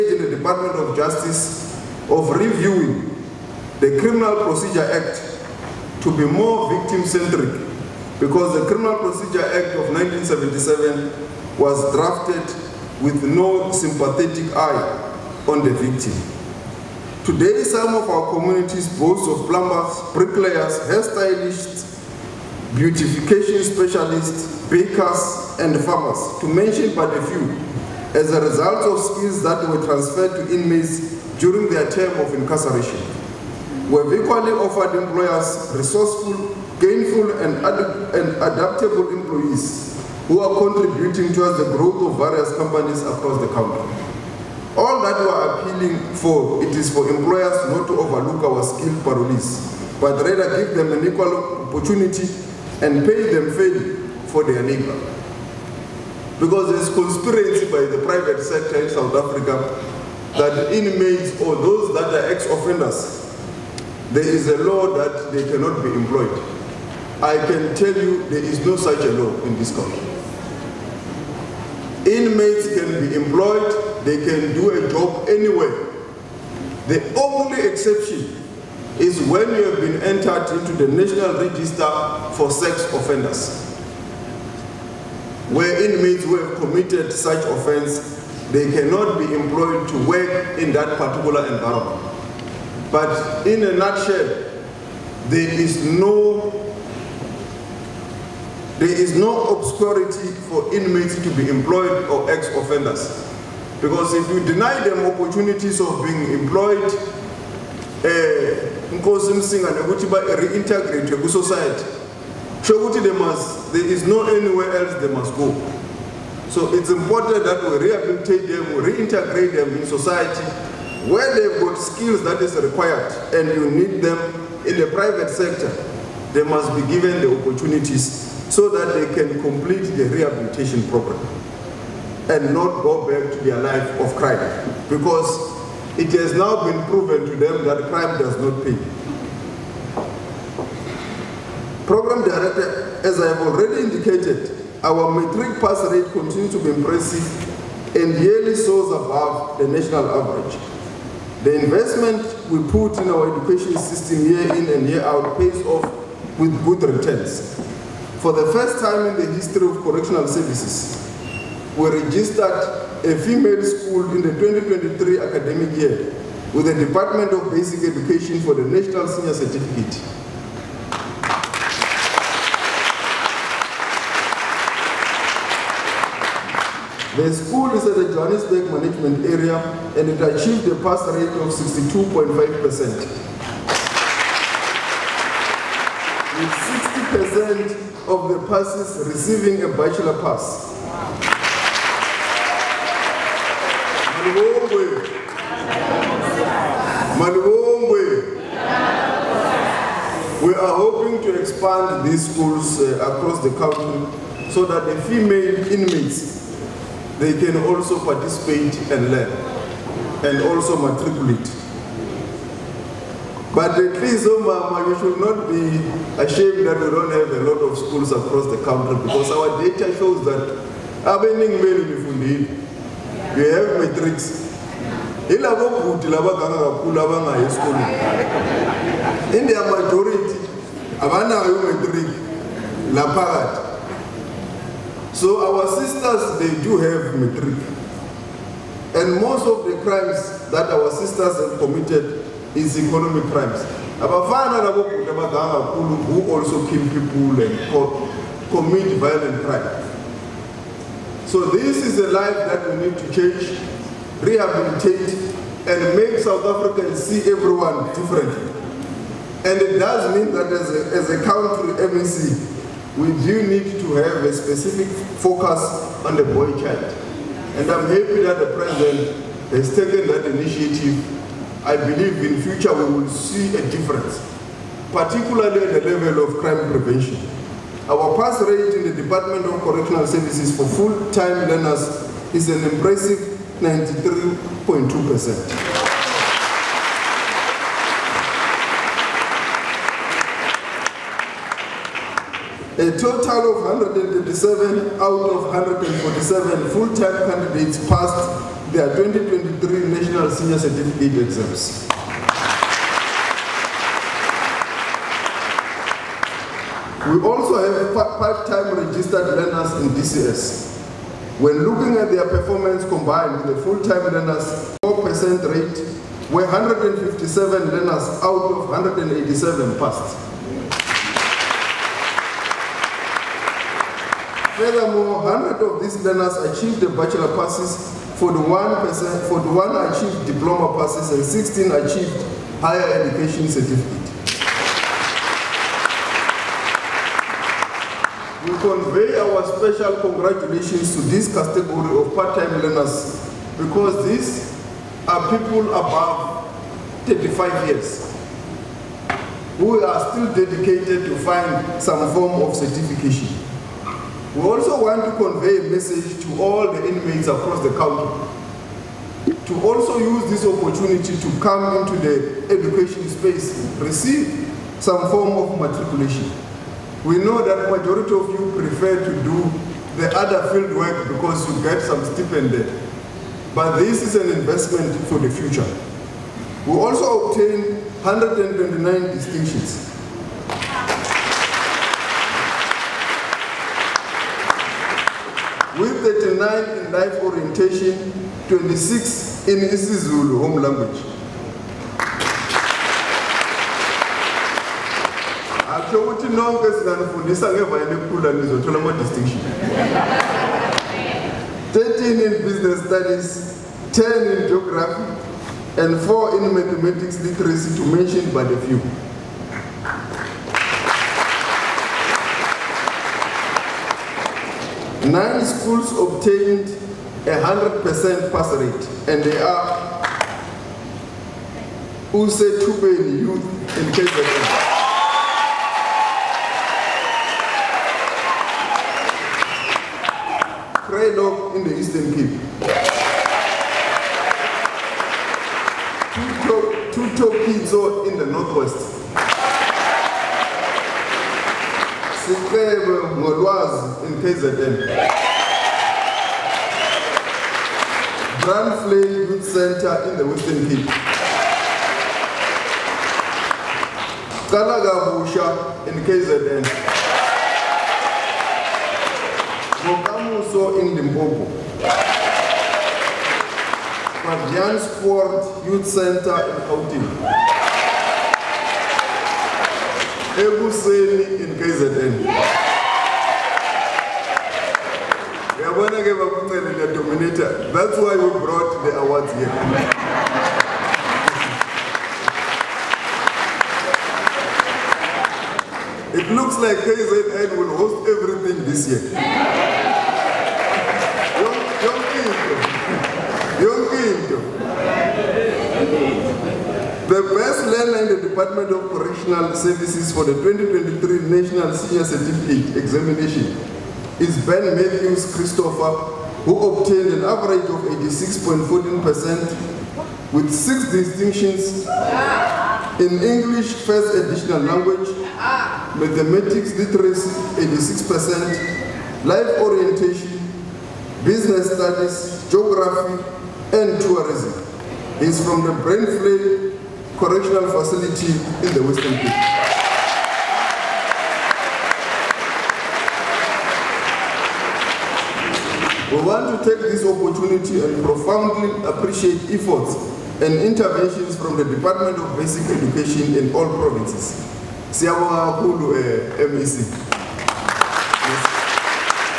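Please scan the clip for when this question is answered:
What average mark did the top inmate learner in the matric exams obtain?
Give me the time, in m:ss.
8:27.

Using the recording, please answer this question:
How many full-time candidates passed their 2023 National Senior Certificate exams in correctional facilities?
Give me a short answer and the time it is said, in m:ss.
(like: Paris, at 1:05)
137, at 4:53.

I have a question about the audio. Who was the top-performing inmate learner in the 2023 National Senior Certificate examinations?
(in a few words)
Ben Matthews Christopher.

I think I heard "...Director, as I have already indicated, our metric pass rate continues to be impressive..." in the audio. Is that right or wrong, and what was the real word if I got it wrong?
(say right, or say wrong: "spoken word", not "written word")
right.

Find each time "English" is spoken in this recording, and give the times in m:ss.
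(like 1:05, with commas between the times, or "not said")
8:33.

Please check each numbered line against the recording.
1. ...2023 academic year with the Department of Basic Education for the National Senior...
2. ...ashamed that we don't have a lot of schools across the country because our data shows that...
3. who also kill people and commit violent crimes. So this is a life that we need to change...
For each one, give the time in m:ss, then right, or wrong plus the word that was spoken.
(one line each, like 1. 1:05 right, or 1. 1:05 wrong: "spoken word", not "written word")
1. 2:44 right
2. 3:36 right
3. 4:03 right.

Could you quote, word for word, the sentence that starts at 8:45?
He's from the Brainfield correctional facility in the Western Cape.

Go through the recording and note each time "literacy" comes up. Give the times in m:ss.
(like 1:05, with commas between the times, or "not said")
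6:47, 8:36.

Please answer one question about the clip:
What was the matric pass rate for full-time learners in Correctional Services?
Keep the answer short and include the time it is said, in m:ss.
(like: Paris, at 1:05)
93.2%, at 4:43.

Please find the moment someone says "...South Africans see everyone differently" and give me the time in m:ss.
4:16.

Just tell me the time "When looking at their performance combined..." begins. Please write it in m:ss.
5:11.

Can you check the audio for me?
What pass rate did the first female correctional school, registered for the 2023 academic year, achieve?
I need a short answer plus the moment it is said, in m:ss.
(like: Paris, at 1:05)
62.5%, at 3:01.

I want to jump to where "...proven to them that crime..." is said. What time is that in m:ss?
2:16.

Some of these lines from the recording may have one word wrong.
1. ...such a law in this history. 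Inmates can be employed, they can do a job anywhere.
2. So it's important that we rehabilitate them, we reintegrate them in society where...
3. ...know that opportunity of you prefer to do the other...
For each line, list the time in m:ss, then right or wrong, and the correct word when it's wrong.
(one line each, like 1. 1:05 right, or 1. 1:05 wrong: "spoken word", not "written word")
1. 1:08 wrong: "country", not "history"
2. 1:56 right
3. 6:07 wrong: "majority", not "opportunity".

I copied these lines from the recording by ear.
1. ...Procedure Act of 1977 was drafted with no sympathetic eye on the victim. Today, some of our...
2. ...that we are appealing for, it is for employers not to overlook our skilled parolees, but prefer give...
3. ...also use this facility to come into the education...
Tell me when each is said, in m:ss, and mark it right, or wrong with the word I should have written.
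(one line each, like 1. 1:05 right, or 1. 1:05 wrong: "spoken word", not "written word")
1. 0:08 right
2. 0:45 wrong: "rather", not "prefer"
3. 5:59 wrong: "opportunity", not "facility".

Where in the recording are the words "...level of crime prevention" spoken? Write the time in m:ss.
4:35.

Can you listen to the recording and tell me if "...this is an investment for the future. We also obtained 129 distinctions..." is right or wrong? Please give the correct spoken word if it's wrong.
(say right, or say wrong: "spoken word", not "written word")
right.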